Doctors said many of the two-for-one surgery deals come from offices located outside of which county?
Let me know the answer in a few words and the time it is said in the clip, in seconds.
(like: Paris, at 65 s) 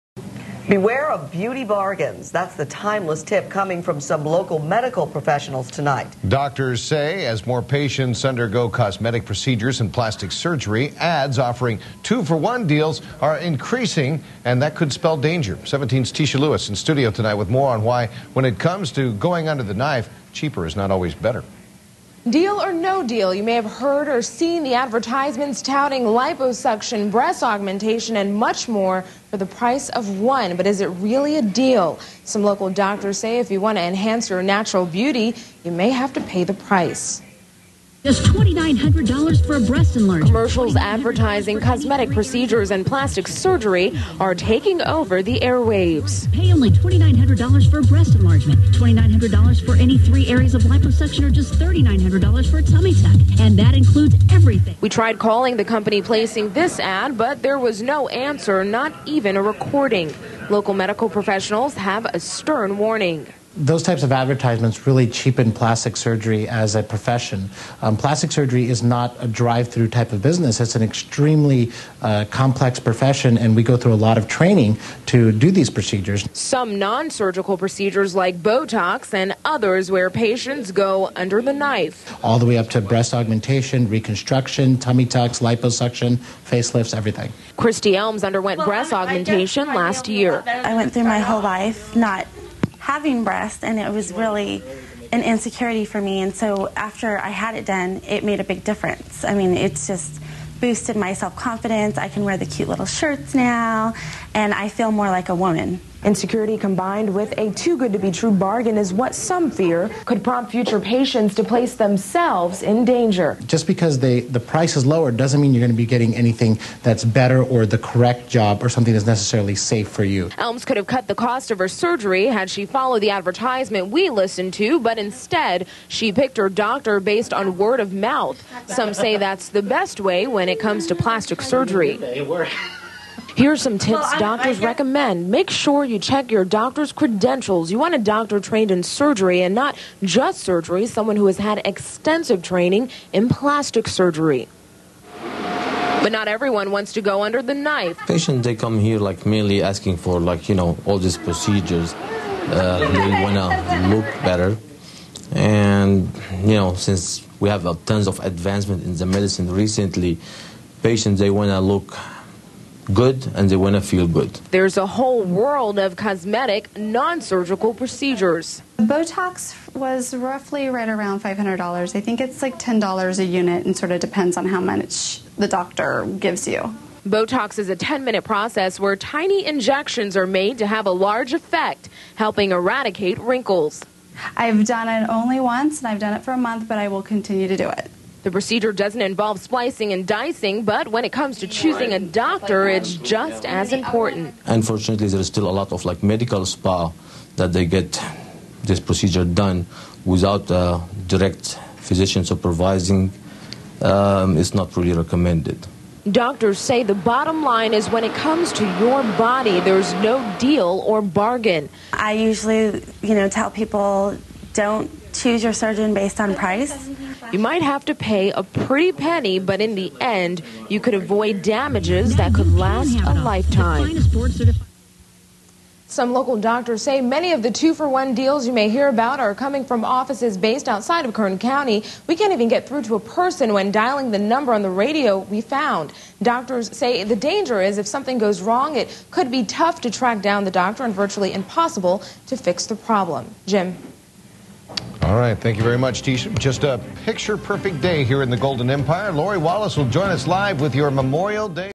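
Kern County, at 231 s.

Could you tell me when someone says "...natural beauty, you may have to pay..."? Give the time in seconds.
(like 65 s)
34 s.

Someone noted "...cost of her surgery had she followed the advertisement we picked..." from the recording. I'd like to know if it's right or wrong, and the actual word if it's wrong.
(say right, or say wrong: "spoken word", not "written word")
wrong: "listened", not "picked".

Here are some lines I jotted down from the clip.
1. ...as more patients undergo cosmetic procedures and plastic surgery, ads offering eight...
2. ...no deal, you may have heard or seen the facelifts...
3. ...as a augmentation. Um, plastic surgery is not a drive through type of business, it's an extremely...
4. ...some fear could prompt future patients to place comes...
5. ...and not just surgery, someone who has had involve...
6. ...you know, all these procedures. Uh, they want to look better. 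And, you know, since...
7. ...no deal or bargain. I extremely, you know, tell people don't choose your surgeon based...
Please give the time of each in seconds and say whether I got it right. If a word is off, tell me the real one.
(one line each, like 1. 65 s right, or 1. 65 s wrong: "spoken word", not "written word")
1. 7 s wrong: "two", not "eight"
2. 22 s wrong: "advertisements", not "facelifts"
3. 66 s wrong: "profession", not "augmentation"
4. 109 s wrong: "themselves", not "comes"
5. 139 s wrong: "extensive", not "involve"
6. 150 s right
7. 209 s wrong: "usually", not "extremely".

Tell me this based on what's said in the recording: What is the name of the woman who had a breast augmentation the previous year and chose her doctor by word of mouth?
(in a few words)
Christy Elms.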